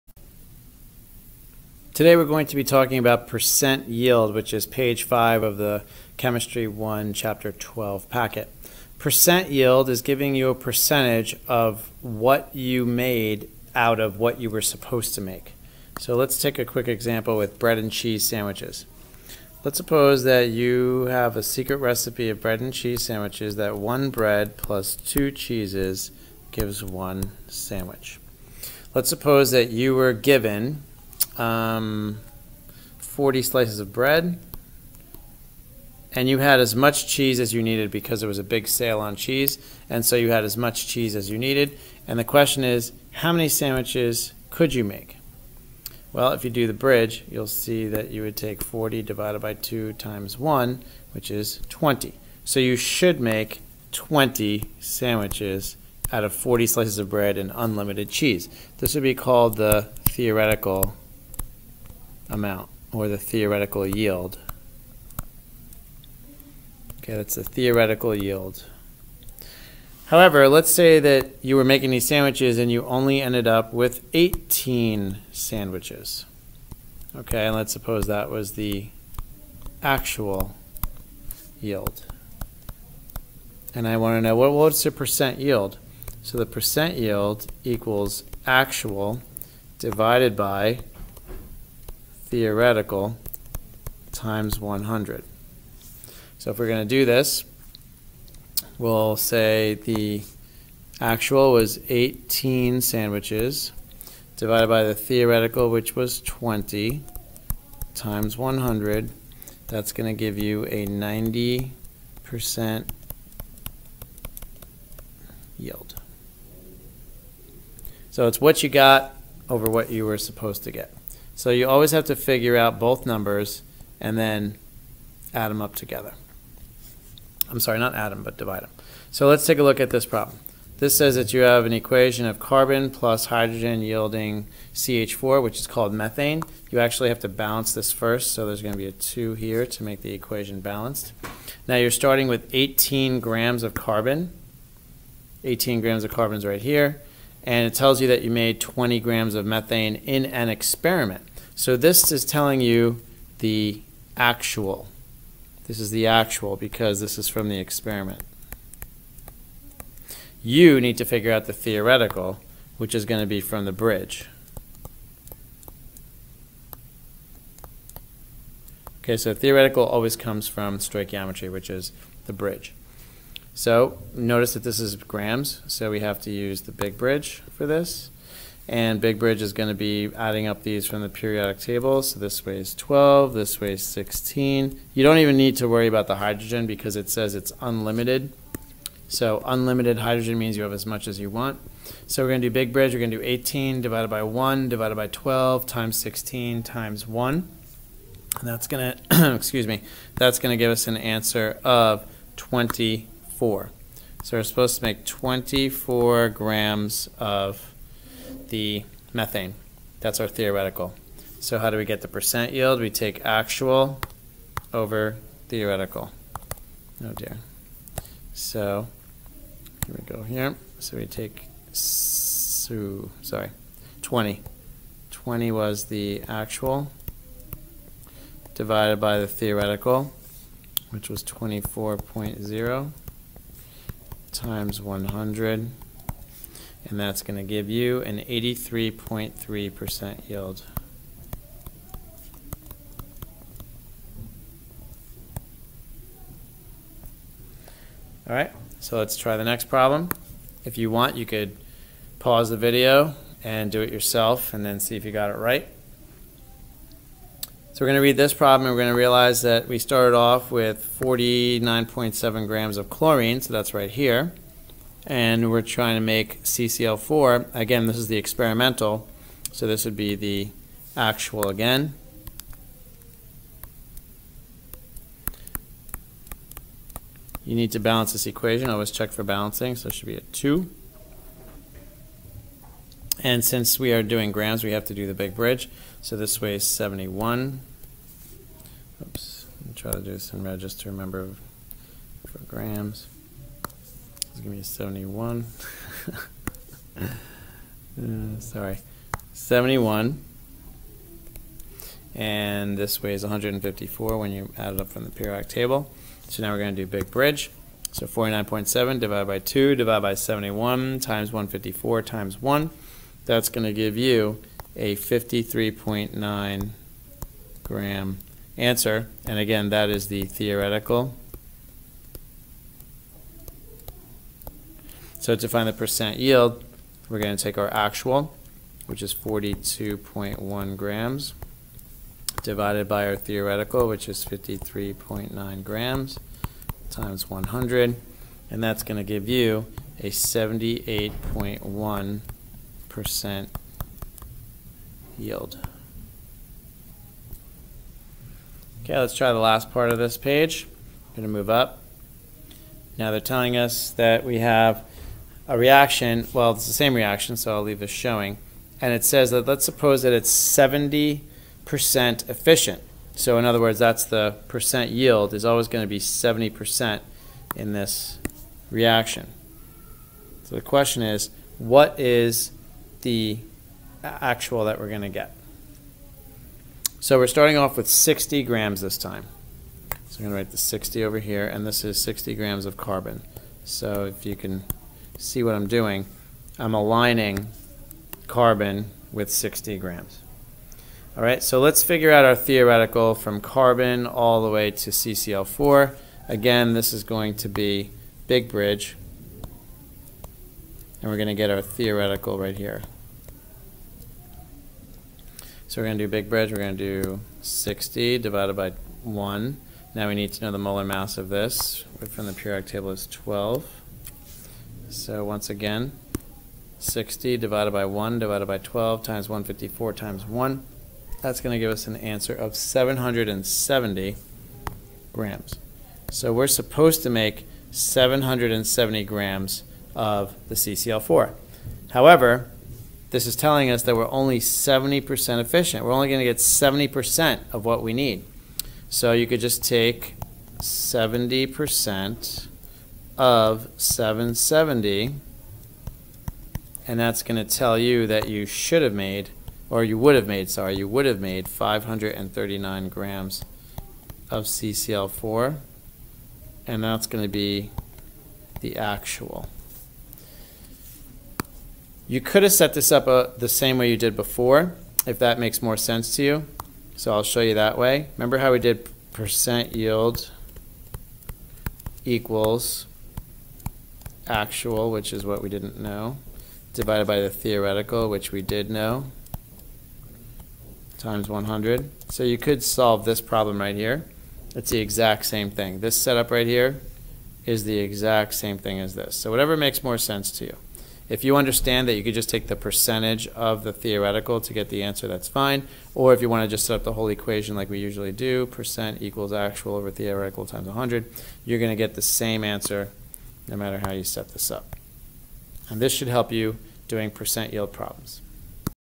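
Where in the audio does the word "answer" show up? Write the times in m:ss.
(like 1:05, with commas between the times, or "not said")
3:20, 5:18, 7:01, 8:14, 8:22.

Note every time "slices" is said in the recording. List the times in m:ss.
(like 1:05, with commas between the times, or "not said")
0:33, 0:56.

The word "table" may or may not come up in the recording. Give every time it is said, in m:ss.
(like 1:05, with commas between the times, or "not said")
3:01, 5:05, 6:52.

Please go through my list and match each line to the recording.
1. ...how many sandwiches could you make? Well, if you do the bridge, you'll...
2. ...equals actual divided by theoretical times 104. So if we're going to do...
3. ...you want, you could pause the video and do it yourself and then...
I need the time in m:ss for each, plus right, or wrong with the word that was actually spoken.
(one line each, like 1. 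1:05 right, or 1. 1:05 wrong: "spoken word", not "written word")
1. 0:43 right
2. 1:27 wrong: "100", not "104"
3. 4:10 right.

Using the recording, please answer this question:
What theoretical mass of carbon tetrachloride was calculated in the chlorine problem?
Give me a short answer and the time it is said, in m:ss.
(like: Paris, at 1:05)
53.9 grams, at 5:14.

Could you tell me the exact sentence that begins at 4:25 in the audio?
And we're trying to make CCl4.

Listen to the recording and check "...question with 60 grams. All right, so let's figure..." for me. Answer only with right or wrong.
wrong.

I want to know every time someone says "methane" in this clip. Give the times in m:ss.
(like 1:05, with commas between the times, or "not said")
2:15, 2:29, 3:29.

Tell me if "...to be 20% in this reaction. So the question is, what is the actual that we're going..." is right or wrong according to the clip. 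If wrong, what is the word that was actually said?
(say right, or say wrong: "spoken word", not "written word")
wrong: "70", not "20".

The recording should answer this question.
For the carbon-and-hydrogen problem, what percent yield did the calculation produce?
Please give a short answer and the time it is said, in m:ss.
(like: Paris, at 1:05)
83.3%, at 3:58.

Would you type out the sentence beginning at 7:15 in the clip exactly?
We're only going to get 70% of what we need.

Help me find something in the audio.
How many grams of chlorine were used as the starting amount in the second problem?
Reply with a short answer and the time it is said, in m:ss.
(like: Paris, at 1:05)
49.7 grams, at 4:21.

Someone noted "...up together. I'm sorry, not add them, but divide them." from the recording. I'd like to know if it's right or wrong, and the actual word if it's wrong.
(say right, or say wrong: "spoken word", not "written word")
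right.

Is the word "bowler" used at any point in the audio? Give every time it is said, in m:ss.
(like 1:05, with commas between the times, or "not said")
not said.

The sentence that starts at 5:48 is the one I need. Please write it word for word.
Okay, let's try the last part of this page.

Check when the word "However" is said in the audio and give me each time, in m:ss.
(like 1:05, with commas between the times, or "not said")
1:10, 7:11.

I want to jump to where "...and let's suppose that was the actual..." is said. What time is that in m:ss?
1:17.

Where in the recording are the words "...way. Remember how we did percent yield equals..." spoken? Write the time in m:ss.
7:47.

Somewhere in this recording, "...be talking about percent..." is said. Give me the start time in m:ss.
0:02.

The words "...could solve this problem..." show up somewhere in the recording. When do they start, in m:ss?
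8:02.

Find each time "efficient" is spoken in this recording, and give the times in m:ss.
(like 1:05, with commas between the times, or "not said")
6:02, 7:15.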